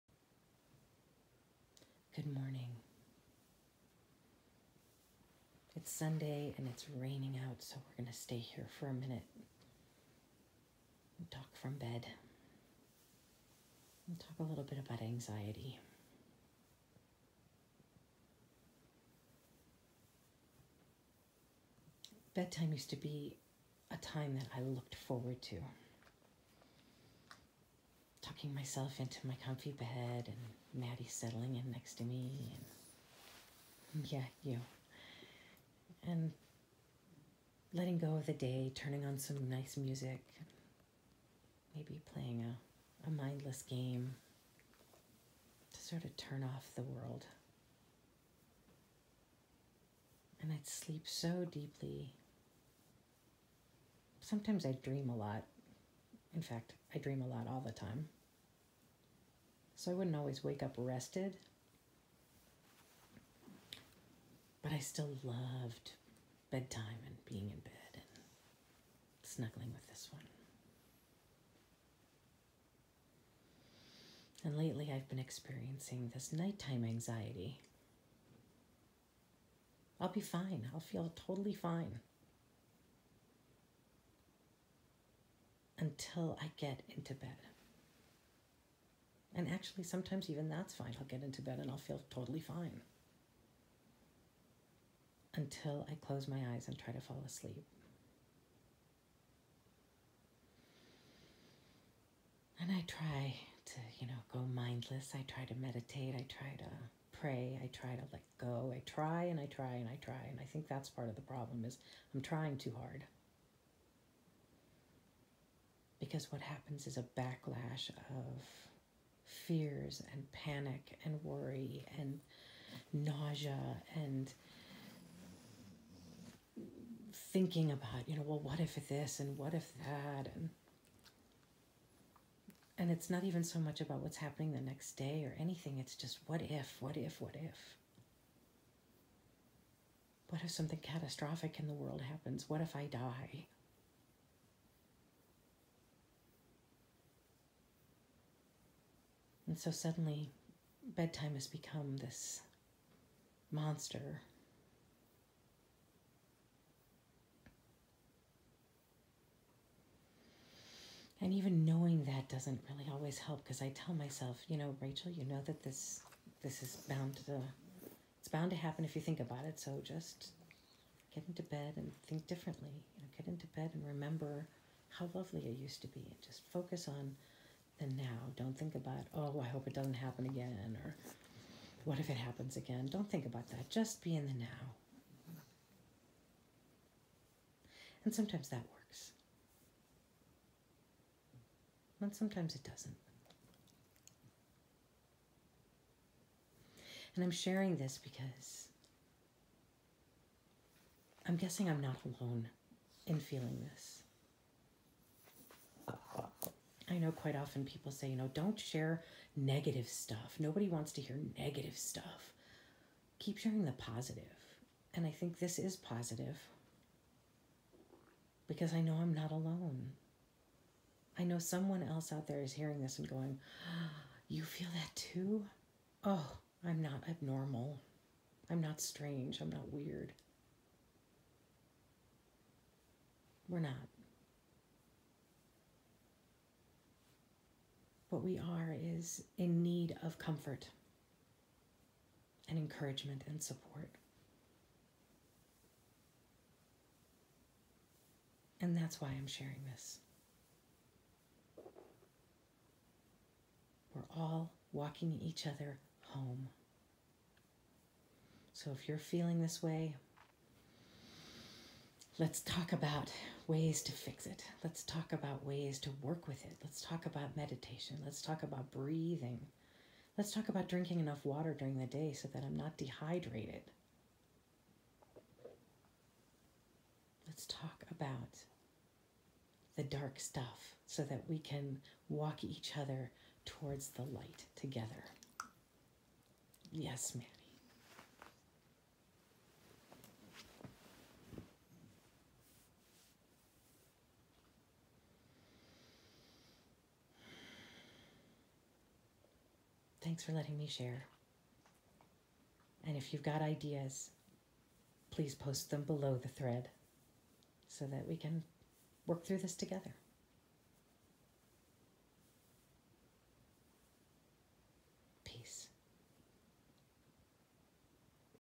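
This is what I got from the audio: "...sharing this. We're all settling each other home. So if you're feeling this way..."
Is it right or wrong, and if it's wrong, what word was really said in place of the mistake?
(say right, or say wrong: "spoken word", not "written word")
wrong: "walking", not "settling".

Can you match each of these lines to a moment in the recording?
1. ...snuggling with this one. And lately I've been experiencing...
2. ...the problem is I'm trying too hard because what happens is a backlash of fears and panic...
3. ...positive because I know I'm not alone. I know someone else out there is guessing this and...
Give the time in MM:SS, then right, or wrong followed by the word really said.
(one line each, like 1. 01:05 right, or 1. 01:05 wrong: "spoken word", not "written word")
1. 01:09 right
2. 01:51 right
3. 03:35 wrong: "hearing", not "guessing".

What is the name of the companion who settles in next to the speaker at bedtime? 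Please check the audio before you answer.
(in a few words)
Maddie.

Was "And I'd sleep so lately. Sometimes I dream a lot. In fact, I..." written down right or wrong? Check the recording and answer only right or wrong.
wrong.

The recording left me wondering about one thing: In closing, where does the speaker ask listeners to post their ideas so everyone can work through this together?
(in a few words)
Below the thread.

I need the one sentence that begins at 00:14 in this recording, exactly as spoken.
And talk a little bit about anxiety.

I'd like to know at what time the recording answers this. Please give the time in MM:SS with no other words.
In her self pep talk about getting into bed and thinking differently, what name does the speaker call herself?
02:44.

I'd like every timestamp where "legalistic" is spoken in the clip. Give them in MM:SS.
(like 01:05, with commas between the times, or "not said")
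not said.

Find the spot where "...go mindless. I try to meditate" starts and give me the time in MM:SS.
01:44.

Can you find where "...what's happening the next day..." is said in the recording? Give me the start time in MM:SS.
02:13.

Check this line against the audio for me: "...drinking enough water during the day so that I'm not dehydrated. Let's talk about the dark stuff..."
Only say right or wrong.
right.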